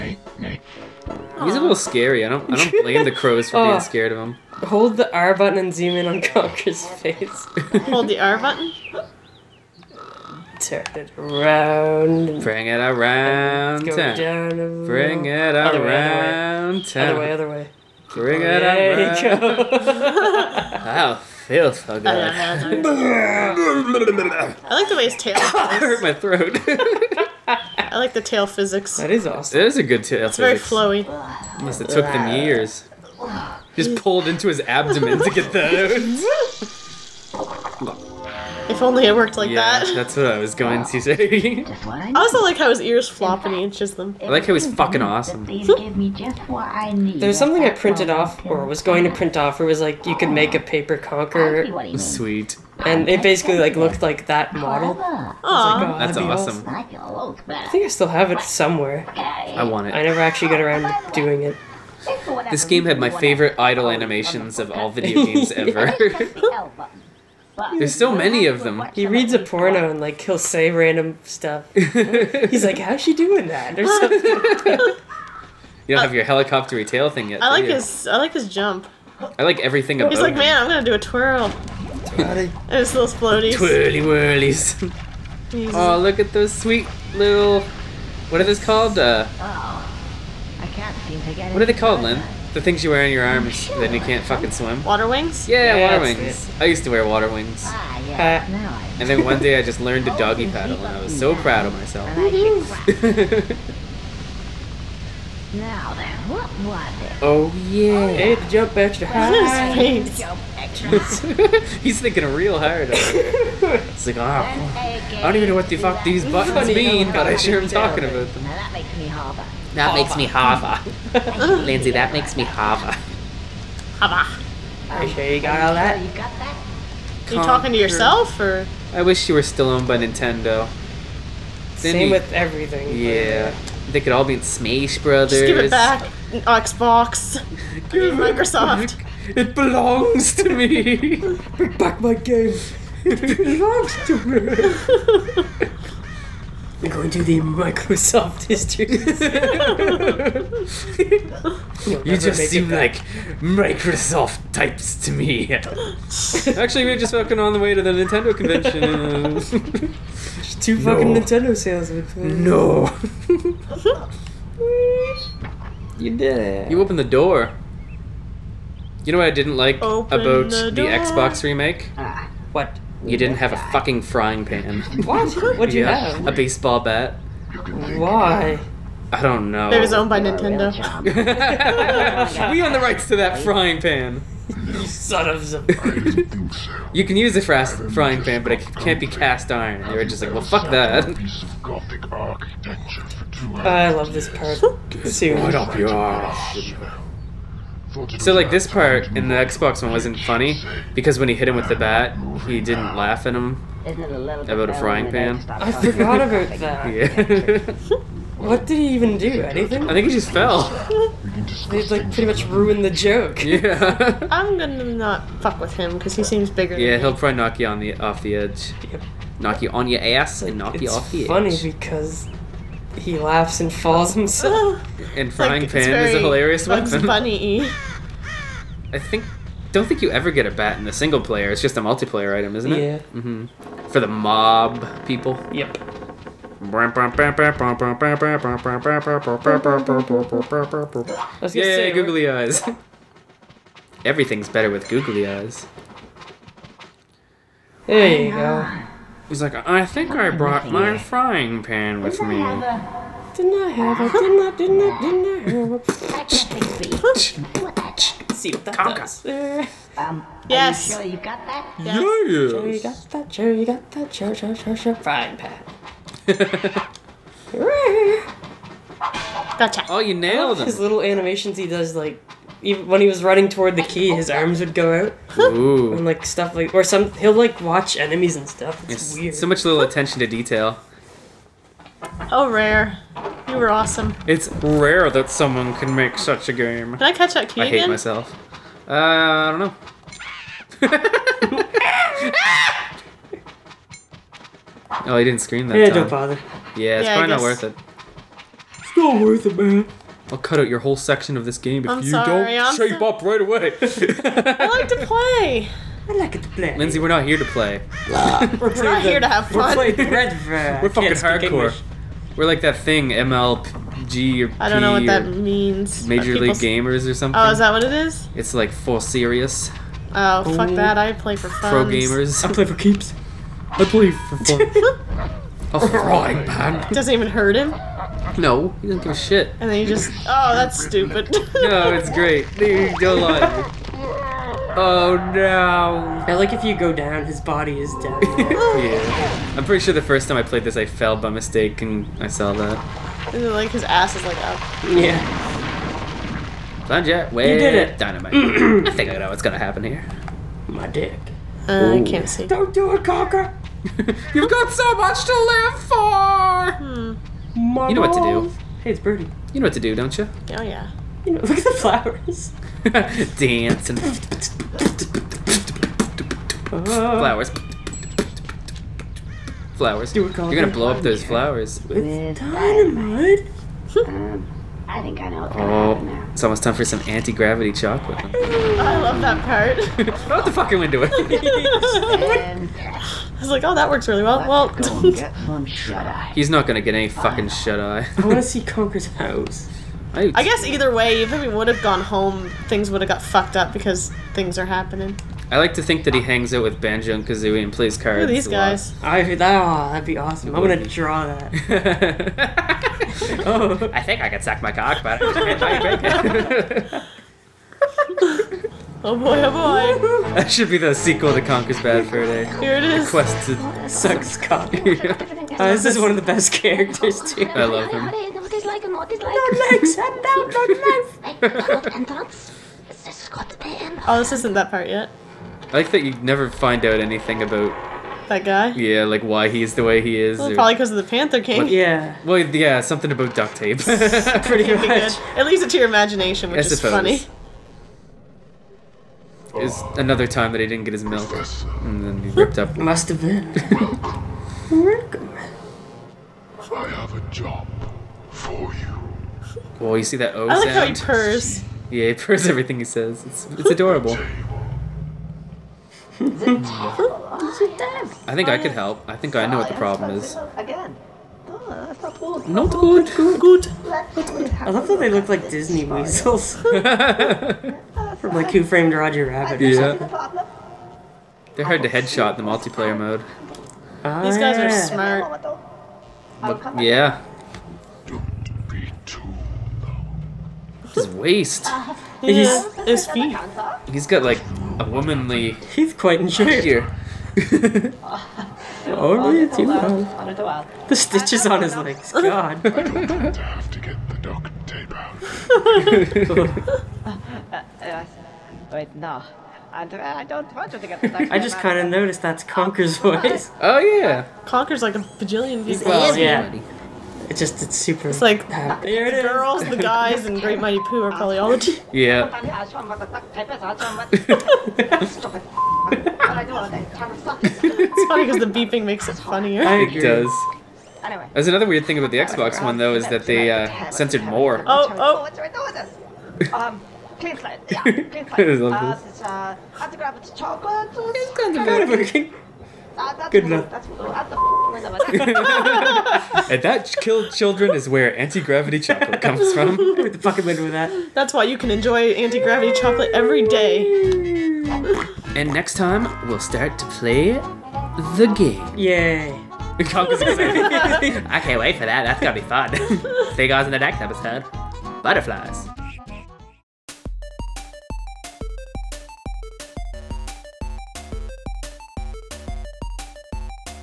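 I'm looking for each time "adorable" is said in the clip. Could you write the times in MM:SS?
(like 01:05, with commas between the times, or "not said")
07:33.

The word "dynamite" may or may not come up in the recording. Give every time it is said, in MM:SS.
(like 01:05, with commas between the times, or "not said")
05:47, 06:12.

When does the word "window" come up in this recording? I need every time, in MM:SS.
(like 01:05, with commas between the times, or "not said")
06:20, 09:00.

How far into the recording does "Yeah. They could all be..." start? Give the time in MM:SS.
02:12.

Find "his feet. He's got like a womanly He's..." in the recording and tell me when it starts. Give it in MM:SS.
08:02.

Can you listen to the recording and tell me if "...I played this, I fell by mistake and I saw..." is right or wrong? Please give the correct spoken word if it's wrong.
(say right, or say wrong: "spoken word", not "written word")
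right.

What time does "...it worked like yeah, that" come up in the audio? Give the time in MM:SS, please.
00:39.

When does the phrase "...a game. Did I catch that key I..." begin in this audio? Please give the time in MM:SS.
04:46.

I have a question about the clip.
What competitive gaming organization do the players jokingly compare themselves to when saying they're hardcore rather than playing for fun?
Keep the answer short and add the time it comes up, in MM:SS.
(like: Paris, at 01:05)
MLG, at 05:13.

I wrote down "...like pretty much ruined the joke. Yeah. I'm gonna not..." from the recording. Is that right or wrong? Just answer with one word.
right.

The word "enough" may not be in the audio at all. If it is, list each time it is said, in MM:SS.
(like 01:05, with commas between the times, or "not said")
08:53.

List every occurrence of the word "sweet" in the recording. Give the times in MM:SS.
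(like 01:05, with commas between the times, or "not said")
00:51, 01:26.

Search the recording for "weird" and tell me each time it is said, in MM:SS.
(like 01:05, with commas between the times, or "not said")
04:39, 08:41.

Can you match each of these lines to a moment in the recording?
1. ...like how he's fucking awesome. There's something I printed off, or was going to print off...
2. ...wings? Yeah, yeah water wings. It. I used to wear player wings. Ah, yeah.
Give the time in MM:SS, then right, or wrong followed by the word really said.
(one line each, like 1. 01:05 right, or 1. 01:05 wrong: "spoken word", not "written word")
1. 00:44 right
2. 01:35 wrong: "water", not "player".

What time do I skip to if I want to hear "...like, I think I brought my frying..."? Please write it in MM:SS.
04:09.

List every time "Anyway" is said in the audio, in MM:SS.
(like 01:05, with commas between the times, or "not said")
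08:41.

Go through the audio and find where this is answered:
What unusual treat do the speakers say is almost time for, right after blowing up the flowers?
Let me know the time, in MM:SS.
06:17.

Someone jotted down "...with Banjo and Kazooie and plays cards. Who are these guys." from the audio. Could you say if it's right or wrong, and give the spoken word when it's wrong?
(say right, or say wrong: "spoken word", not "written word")
right.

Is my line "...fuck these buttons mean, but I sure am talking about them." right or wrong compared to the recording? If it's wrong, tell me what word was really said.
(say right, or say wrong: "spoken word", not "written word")
right.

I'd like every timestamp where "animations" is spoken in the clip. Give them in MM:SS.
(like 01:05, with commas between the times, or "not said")
01:03, 04:31.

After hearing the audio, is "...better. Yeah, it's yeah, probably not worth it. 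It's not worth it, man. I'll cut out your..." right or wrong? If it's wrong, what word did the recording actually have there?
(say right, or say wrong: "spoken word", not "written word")
wrong: "bother", not "better".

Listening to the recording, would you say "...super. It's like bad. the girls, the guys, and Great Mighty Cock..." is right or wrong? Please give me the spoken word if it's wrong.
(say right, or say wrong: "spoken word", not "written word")
wrong: "Poo", not "Cock".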